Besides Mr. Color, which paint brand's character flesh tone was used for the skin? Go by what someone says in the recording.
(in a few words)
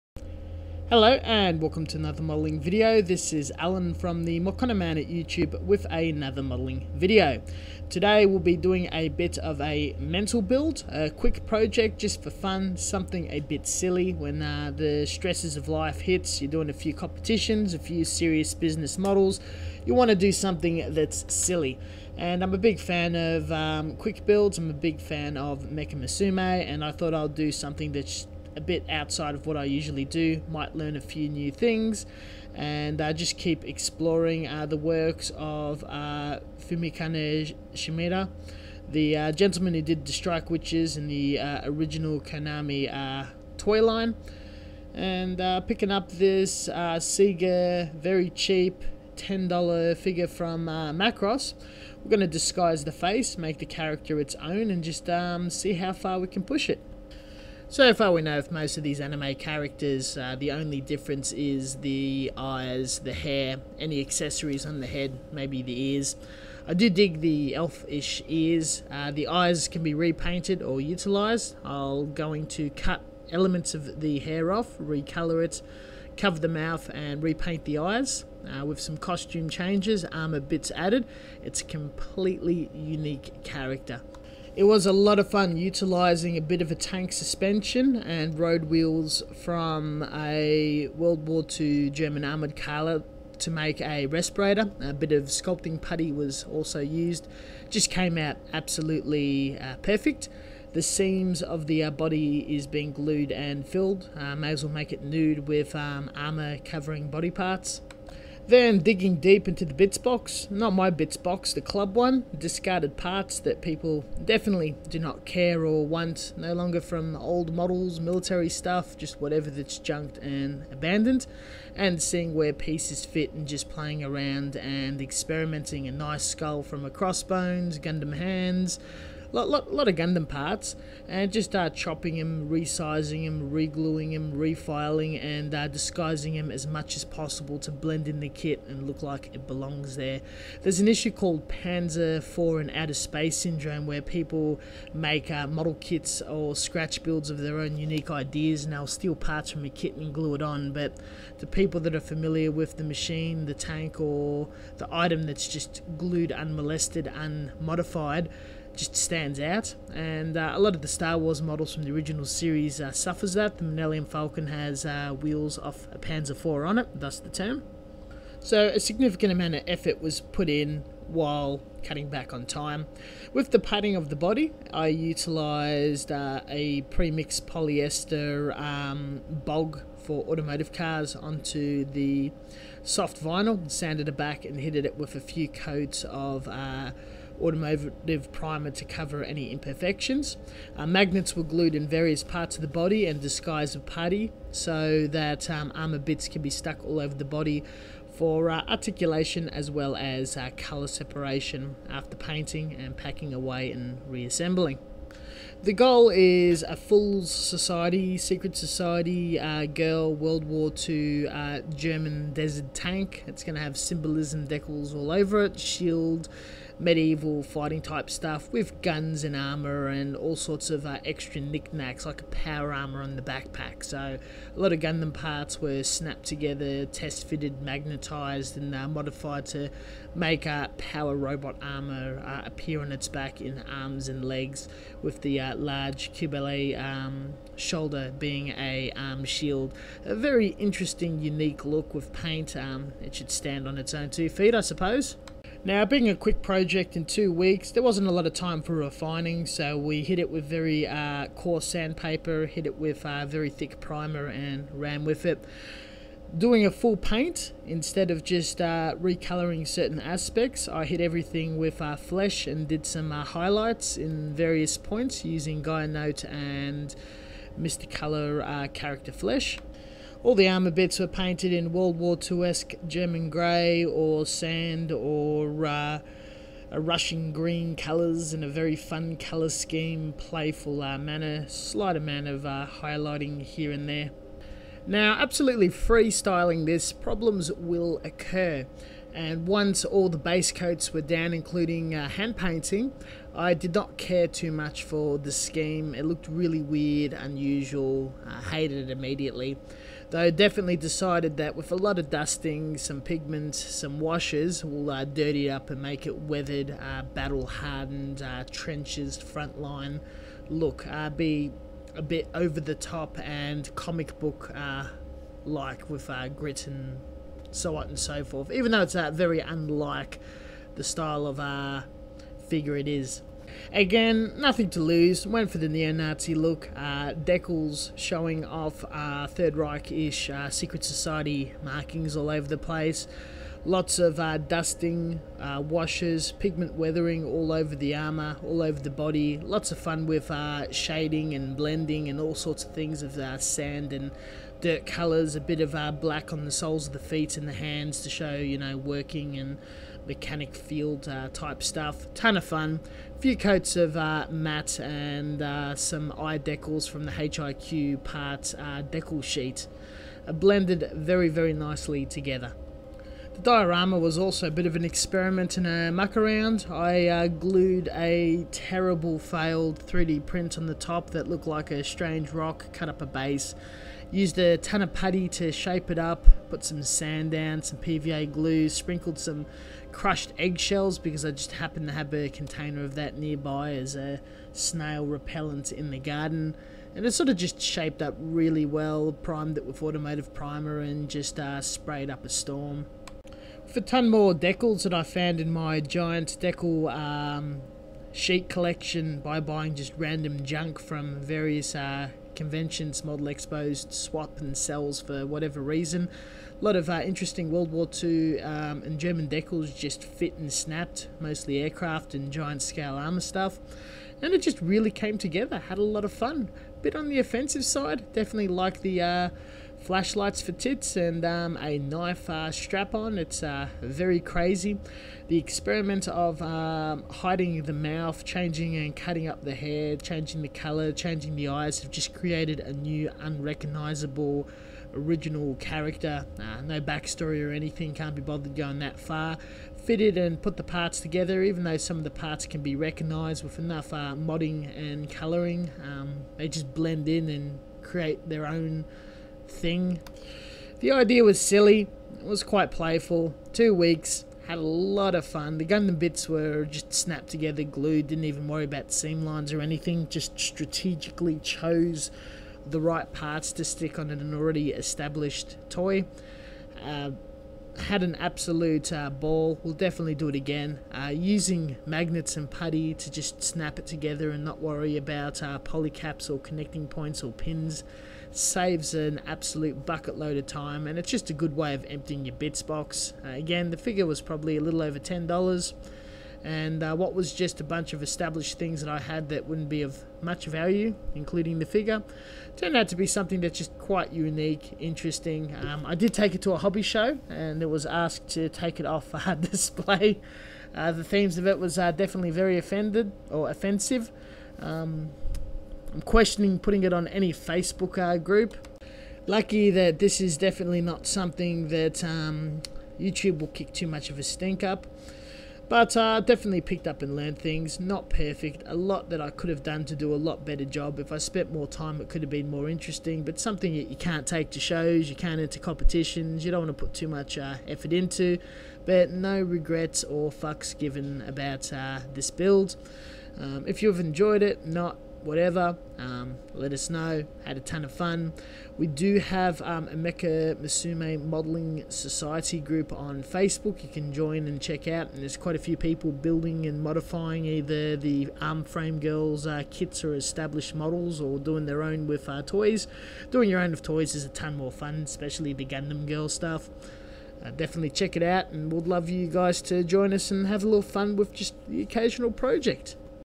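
Gaianote.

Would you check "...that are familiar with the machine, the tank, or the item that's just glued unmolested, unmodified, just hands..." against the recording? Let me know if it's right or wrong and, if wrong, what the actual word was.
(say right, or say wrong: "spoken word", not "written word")
wrong: "stands", not "hands".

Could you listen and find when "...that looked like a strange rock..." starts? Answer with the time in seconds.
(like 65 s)
371 s.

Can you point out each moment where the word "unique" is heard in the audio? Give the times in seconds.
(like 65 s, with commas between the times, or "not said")
82 s, 147 s, 241 s, 494 s.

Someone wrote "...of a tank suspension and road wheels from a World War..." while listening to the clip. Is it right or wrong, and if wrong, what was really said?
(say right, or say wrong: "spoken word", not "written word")
right.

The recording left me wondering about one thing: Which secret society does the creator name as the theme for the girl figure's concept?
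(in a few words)
Thule society.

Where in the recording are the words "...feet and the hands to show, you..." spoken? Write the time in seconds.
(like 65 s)
346 s.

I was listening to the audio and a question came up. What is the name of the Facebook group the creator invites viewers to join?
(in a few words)
Mecha Musume Modeling Society.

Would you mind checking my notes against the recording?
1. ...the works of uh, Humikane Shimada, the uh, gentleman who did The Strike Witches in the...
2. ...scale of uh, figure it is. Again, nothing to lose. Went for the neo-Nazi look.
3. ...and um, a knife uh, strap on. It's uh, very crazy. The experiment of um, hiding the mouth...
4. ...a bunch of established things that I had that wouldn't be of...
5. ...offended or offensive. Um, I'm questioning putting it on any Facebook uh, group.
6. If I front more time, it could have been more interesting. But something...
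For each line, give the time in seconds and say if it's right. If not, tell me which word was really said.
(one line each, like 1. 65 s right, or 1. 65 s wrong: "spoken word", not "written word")
1. 34 s right
2. 320 s wrong: "style", not "scale"
3. 420 s right
4. 487 s right
5. 502 s right
6. 520 s wrong: "spent", not "front".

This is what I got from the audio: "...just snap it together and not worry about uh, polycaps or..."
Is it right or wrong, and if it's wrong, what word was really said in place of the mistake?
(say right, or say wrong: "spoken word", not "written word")
right.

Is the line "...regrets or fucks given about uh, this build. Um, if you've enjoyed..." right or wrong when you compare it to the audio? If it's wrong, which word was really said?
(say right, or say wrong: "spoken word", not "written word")
right.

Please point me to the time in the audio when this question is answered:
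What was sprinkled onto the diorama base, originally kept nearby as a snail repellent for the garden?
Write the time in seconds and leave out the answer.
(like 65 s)
379 s.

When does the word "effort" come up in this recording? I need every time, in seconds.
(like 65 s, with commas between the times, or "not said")
169 s, 527 s.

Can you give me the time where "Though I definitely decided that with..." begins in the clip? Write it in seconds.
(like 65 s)
300 s.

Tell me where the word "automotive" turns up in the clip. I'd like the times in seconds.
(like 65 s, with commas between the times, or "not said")
180 s, 187 s, 389 s.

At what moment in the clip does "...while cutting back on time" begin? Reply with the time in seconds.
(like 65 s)
171 s.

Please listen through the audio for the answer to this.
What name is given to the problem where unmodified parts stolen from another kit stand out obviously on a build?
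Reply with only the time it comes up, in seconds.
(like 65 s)
141 s.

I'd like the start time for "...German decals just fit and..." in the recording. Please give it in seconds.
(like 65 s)
408 s.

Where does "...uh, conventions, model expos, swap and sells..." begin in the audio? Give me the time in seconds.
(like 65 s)
401 s.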